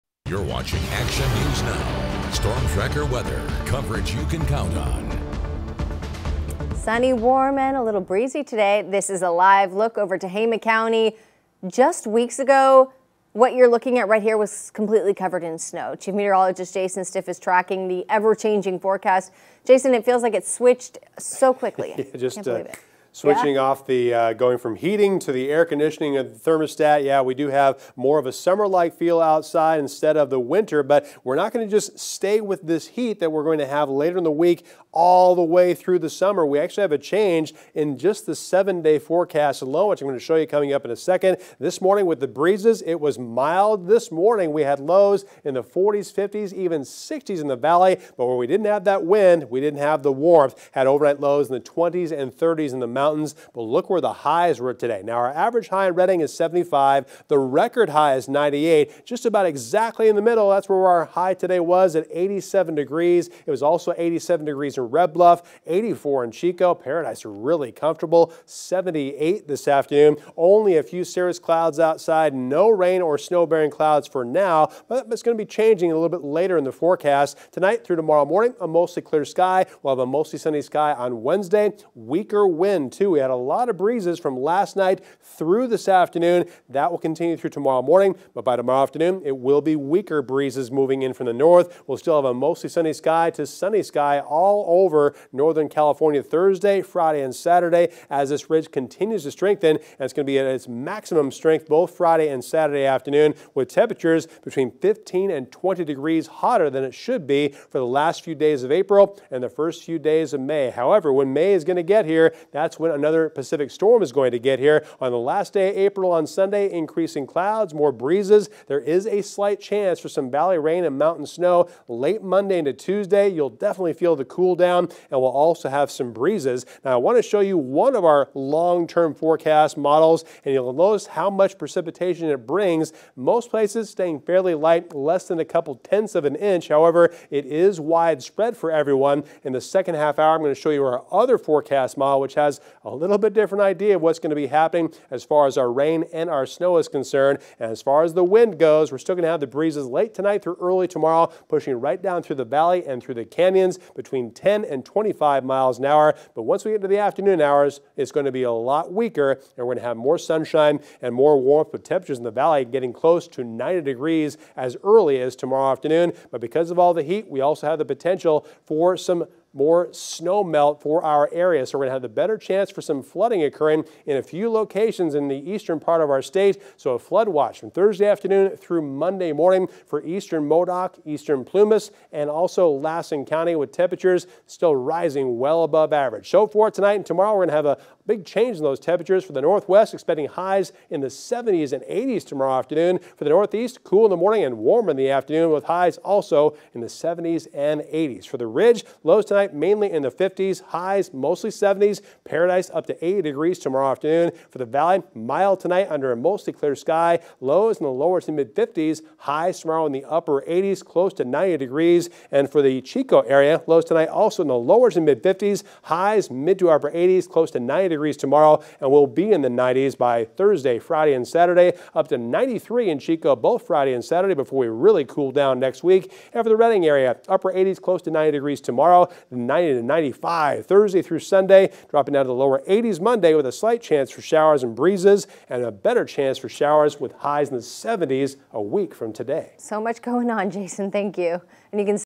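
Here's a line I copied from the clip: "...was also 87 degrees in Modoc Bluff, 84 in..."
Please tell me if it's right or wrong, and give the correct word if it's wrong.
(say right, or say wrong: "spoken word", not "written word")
wrong: "Red", not "Modoc".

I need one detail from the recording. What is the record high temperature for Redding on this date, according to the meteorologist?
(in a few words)
98.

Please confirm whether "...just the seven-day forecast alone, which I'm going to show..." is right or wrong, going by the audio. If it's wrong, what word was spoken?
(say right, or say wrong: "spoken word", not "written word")
right.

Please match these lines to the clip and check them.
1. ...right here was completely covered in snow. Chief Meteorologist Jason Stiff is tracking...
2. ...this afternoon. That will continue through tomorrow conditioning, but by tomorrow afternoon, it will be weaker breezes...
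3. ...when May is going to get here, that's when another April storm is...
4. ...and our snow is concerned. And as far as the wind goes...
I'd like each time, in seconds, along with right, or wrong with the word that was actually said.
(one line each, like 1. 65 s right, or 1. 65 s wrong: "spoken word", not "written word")
1. 14 s right
2. 85 s wrong: "morning", not "conditioning"
3. 111 s wrong: "Pacific", not "April"
4. 146 s right.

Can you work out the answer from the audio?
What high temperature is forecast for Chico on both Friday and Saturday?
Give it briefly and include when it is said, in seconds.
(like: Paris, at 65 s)
93, at 222 s.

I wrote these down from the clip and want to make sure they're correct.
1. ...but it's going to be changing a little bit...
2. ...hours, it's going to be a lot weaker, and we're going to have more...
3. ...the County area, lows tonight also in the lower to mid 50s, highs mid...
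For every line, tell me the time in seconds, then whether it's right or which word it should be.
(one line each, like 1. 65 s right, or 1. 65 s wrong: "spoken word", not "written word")
1. 74 s right
2. 157 s right
3. 212 s wrong: "Chico", not "County".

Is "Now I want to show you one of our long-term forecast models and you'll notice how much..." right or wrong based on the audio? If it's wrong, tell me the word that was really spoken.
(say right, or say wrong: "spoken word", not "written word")
right.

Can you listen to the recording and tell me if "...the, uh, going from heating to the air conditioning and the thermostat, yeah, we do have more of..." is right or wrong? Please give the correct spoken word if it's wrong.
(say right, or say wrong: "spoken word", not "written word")
right.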